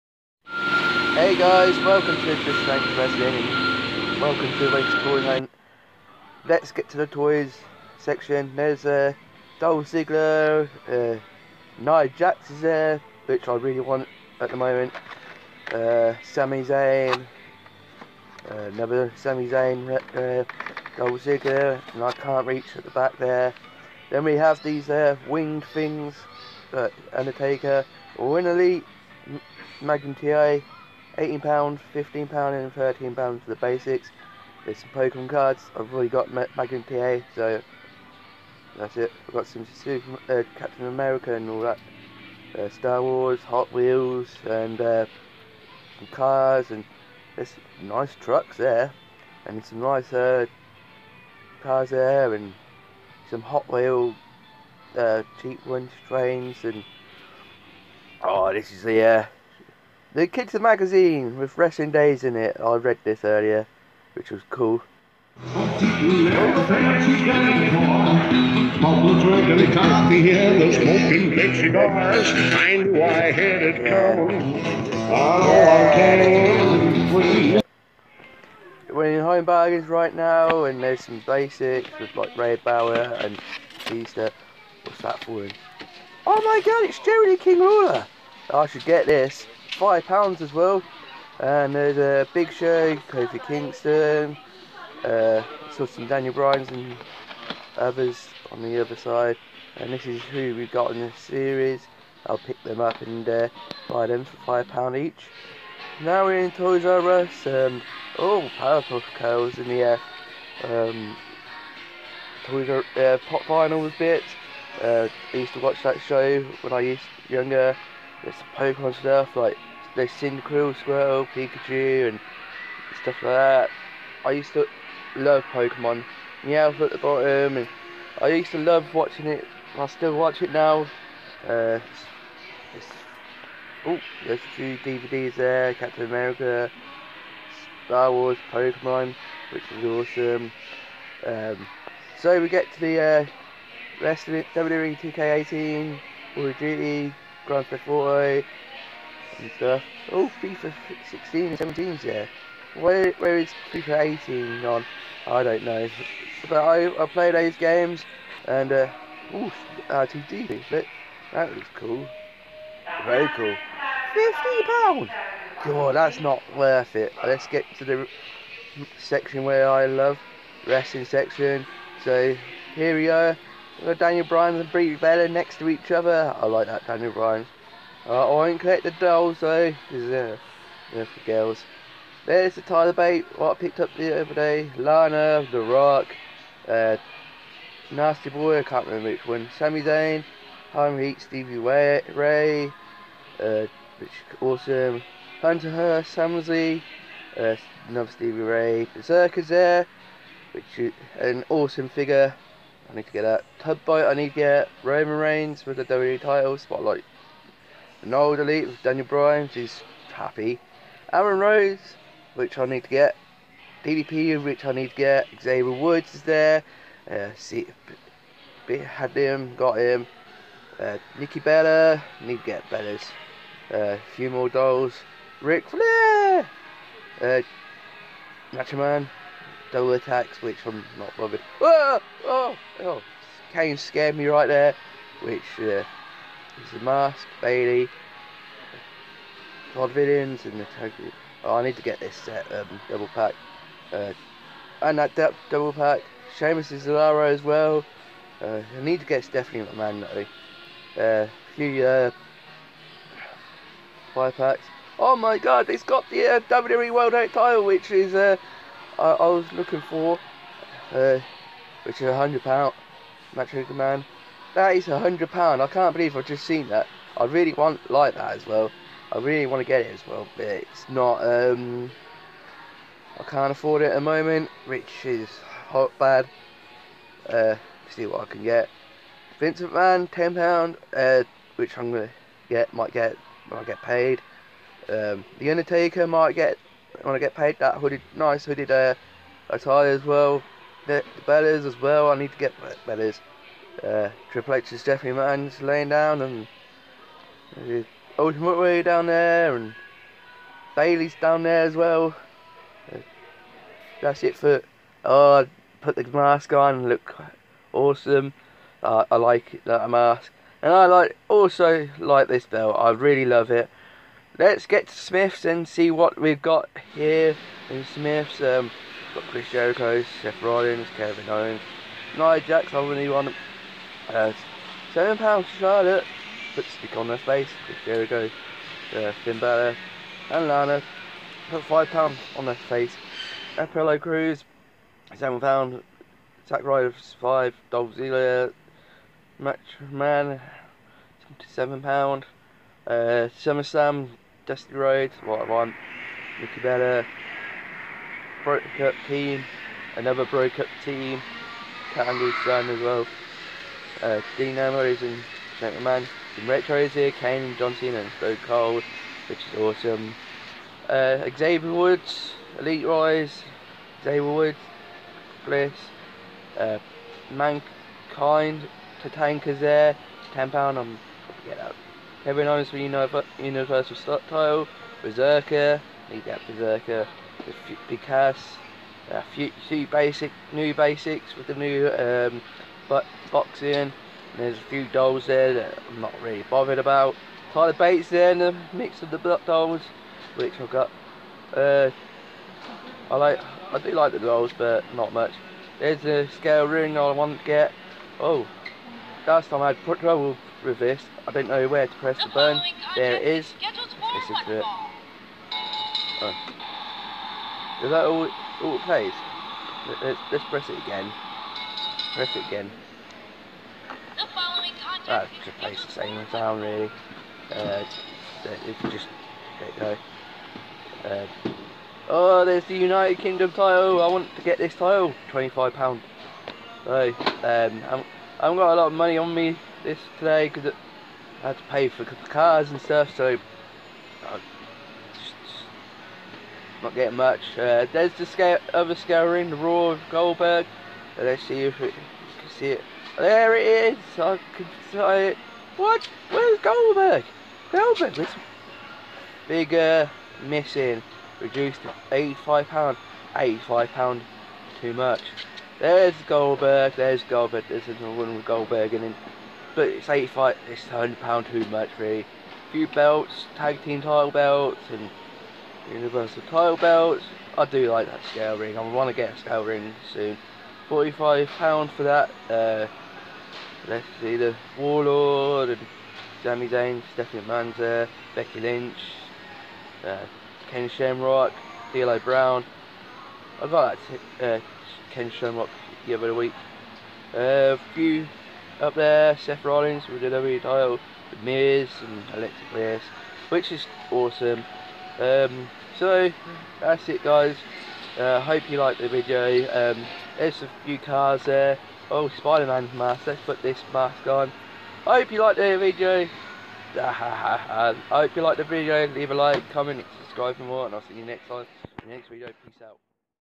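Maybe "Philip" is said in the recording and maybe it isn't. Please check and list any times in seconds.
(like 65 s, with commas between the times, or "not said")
not said.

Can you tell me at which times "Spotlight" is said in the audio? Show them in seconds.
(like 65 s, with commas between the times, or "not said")
206 s.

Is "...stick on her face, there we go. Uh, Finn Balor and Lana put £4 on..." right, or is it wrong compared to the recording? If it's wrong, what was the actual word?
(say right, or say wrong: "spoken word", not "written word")
wrong: "5", not "4".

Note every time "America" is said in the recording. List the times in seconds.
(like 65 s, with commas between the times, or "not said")
40 s, 136 s.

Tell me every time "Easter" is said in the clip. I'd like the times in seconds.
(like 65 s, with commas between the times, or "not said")
83 s.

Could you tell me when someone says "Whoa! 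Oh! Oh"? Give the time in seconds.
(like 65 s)
231 s.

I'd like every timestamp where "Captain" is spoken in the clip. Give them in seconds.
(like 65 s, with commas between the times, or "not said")
40 s, 135 s.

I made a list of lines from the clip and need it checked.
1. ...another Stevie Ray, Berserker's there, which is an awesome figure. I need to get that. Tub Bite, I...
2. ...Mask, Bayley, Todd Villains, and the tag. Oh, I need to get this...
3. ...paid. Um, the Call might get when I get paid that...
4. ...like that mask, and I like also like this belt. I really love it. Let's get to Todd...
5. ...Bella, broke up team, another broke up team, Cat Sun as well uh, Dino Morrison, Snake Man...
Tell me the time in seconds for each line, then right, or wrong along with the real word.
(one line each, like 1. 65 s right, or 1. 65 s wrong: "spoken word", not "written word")
1. 197 s right
2. 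236 s right
3. 283 s wrong: "Undertaker", not "Call"
4. 309 s wrong: "Smiths", not "Todd"
5. 346 s right.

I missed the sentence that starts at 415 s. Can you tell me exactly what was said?
That just plays the same town really.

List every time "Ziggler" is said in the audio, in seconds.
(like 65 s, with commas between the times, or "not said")
9 s, 21 s, 337 s.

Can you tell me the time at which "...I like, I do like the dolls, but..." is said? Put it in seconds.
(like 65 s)
393 s.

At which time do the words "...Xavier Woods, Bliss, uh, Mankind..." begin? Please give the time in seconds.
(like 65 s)
364 s.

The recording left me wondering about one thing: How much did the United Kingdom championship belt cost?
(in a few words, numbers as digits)
£25.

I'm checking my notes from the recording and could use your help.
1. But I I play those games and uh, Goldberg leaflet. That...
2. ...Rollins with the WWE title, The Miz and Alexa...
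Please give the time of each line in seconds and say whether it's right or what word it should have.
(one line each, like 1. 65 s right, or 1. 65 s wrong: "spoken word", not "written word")
1. 156 s wrong: "RTD", not "Goldberg"
2. 489 s right.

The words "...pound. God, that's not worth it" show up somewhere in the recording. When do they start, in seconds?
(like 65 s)
164 s.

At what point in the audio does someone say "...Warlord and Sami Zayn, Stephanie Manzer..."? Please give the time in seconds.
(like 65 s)
474 s.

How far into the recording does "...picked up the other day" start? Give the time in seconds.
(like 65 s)
183 s.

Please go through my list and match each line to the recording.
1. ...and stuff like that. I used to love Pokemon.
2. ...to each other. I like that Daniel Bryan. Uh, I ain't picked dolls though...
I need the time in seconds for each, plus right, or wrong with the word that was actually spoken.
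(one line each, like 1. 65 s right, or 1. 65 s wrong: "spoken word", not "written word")
1. 122 s right
2. 175 s wrong: "collected", not "picked".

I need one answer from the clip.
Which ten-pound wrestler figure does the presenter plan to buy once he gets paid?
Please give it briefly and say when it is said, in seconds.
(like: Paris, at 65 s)
Vincent Van, at 279 s.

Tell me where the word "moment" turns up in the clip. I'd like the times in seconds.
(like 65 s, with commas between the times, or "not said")
14 s, 274 s.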